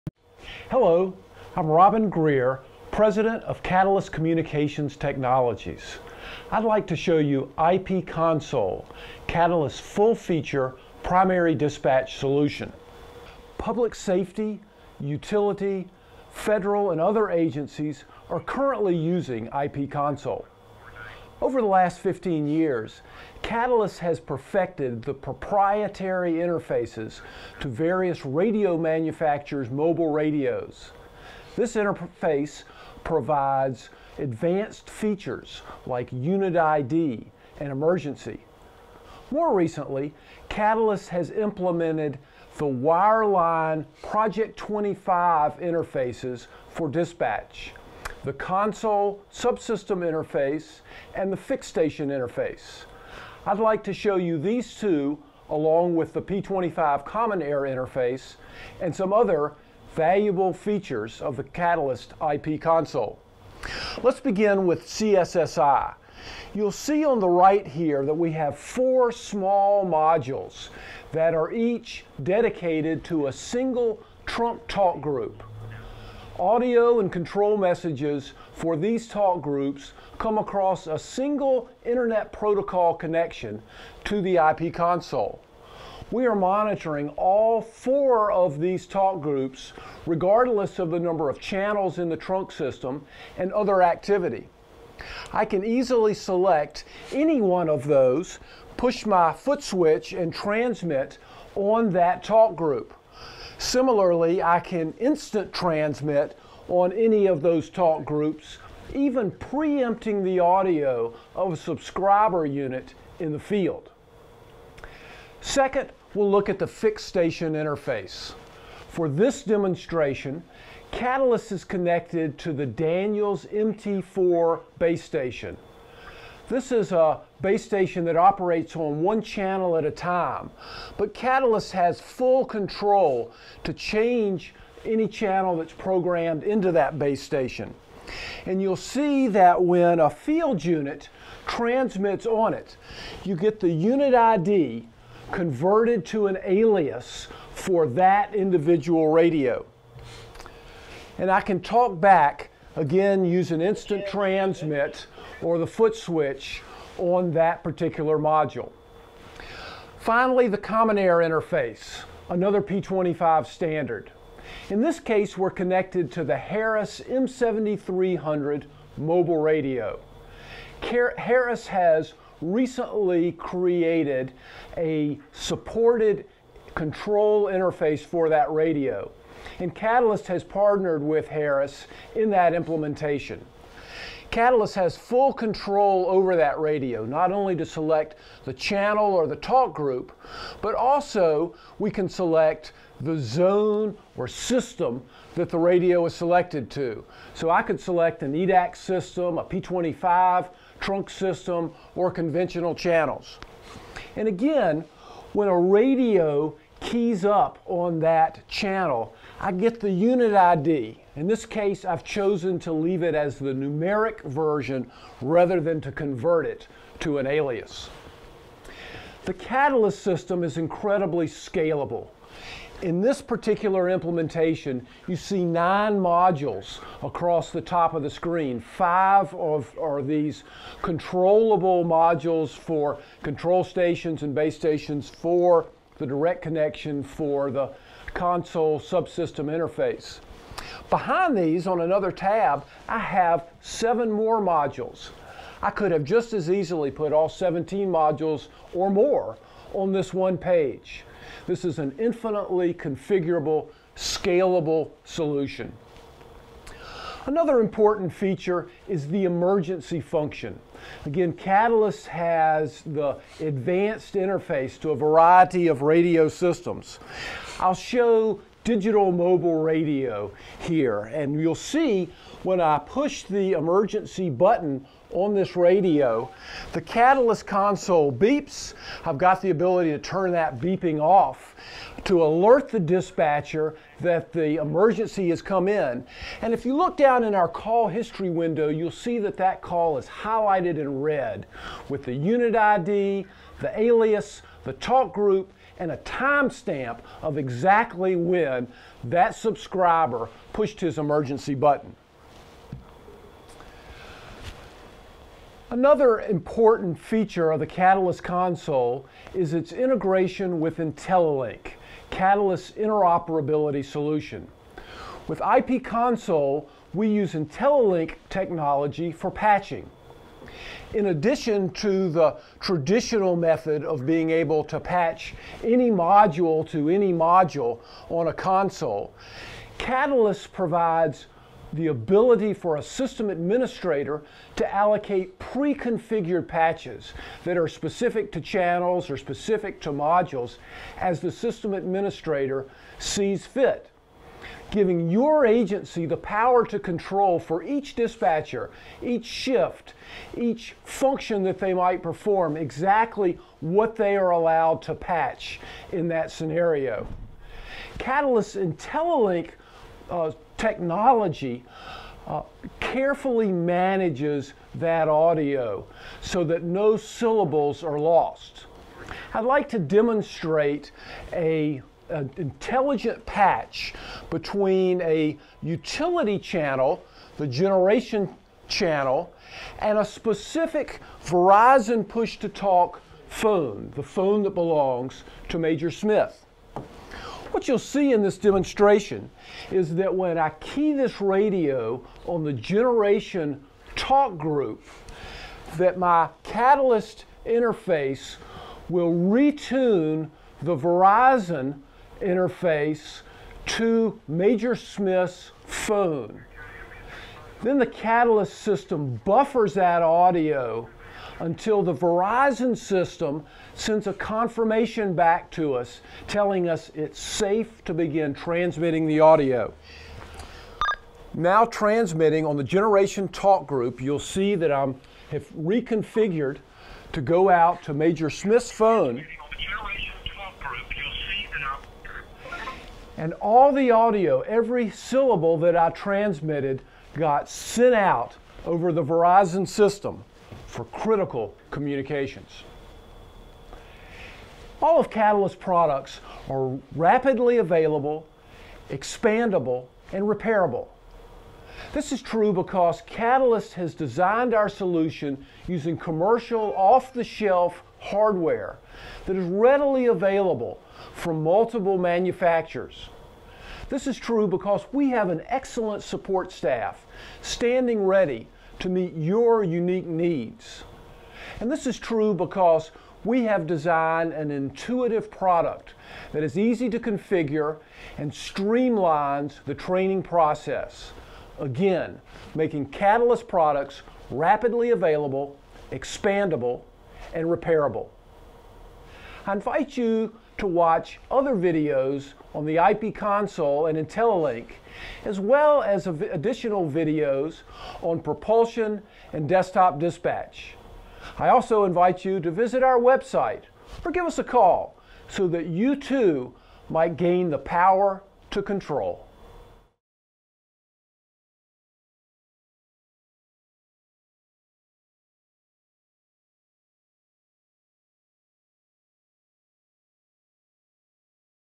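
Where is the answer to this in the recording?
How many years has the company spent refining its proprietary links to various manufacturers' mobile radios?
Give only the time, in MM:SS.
00:22.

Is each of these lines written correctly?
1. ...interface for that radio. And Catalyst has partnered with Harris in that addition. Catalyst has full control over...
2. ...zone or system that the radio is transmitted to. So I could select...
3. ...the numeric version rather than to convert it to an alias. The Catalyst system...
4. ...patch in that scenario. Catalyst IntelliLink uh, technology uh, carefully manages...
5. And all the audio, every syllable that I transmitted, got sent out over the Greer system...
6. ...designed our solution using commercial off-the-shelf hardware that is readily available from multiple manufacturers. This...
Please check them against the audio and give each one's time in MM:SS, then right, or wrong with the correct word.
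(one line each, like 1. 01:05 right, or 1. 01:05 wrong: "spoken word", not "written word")
1. 02:57 wrong: "implementation", not "addition"
2. 03:13 wrong: "selected", not "transmitted"
3. 03:33 right
4. 05:54 right
5. 07:13 wrong: "Verizon", not "Greer"
6. 07:33 right.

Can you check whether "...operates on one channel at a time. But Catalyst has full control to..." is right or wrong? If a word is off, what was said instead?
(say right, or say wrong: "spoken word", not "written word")
right.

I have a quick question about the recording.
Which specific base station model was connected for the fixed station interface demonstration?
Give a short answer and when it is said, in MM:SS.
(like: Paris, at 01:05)
Daniels MT4, at 02:02.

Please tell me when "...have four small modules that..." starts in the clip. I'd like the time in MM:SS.
01:08.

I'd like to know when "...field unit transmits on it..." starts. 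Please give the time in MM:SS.
02:20.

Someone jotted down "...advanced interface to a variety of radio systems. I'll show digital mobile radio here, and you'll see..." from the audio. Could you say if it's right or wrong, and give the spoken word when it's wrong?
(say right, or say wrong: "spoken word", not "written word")
right.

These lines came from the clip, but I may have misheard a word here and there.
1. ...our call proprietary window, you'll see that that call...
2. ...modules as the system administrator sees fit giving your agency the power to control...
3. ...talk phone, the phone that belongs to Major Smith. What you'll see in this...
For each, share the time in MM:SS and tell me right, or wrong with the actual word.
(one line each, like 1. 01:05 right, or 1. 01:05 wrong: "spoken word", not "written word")
1. 04:47 wrong: "history", not "proprietary"
2. 05:39 right
3. 06:22 right.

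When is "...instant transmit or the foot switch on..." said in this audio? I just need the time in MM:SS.
02:33.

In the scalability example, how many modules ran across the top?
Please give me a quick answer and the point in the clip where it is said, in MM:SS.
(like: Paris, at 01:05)
9, at 03:45.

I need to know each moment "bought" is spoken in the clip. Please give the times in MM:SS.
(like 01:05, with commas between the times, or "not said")
not said.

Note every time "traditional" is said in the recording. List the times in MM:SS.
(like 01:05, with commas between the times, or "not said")
05:22.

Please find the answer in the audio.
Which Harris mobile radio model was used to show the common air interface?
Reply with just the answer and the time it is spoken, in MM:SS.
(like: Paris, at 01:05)
M7300, at 02:47.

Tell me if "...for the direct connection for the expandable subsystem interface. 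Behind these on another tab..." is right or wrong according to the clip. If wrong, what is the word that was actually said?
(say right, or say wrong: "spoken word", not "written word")
wrong: "console", not "expandable".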